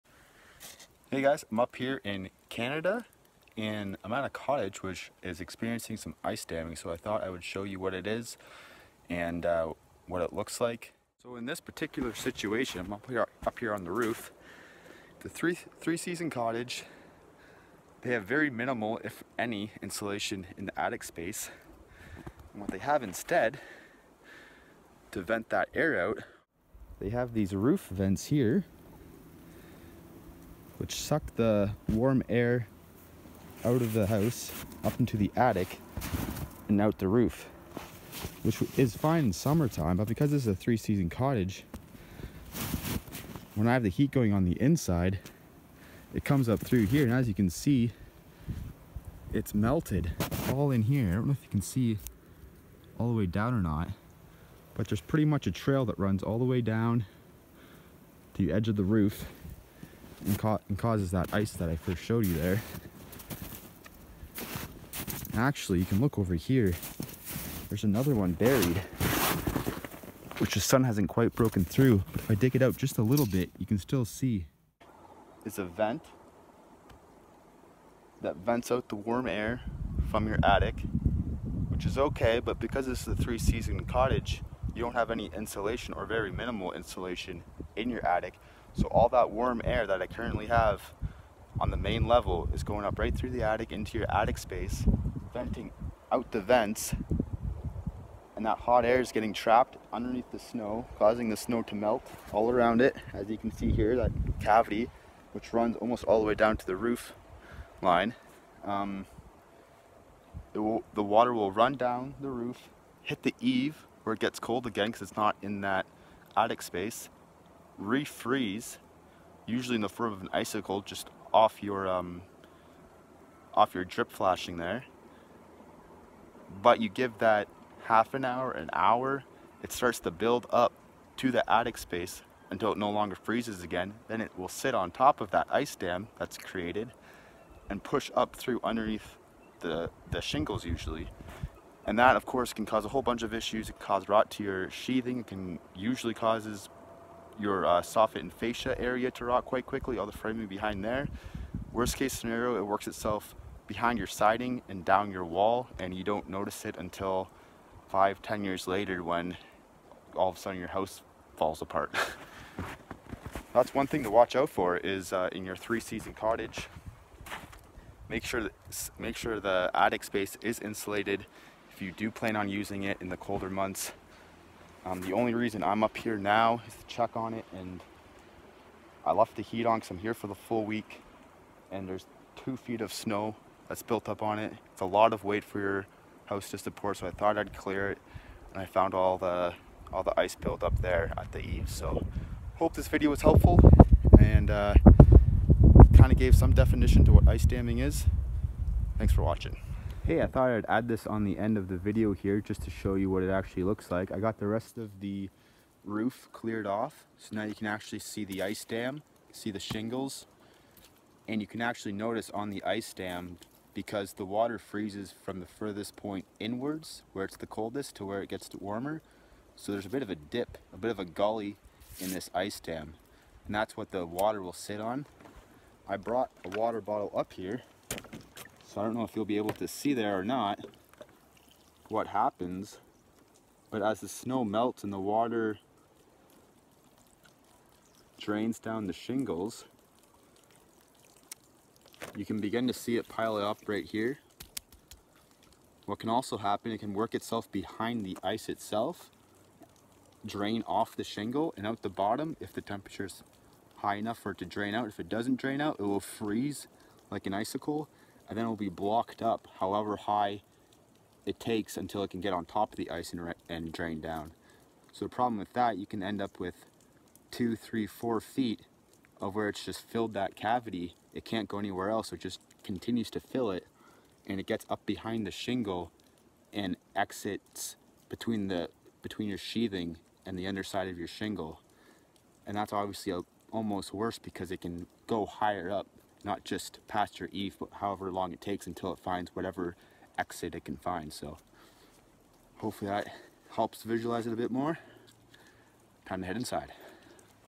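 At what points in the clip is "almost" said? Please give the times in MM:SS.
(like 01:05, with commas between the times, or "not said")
01:45, 04:43.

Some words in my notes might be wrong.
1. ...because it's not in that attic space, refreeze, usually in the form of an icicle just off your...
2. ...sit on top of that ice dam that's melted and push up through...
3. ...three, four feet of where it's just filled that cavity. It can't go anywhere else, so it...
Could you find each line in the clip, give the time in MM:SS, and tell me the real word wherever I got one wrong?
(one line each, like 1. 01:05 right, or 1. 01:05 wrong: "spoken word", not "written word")
1. 01:54 right
2. 02:14 wrong: "created", not "melted"
3. 04:27 right.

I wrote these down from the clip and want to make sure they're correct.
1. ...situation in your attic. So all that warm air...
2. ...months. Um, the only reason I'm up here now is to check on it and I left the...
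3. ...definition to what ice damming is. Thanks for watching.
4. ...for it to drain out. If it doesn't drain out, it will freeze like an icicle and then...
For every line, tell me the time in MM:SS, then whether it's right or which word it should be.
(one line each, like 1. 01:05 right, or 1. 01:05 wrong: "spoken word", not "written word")
1. 01:26 wrong: "insulation", not "situation"
2. 02:53 right
3. 03:16 right
4. 04:14 right.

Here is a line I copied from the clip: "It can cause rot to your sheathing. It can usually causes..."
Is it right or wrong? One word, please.
right.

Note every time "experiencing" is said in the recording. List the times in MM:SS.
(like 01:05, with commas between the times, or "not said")
00:05.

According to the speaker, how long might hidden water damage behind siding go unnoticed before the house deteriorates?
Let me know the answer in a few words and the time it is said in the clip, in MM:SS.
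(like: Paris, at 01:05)
5 to 10 years, at 02:37.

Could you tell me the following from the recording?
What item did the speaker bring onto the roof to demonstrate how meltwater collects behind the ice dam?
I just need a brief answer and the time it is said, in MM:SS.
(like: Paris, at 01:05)
A water bottle, at 03:46.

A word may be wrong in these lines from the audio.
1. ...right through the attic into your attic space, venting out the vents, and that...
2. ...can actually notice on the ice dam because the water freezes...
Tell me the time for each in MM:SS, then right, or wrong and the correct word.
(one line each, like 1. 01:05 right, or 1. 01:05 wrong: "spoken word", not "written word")
1. 01:32 right
2. 03:31 right.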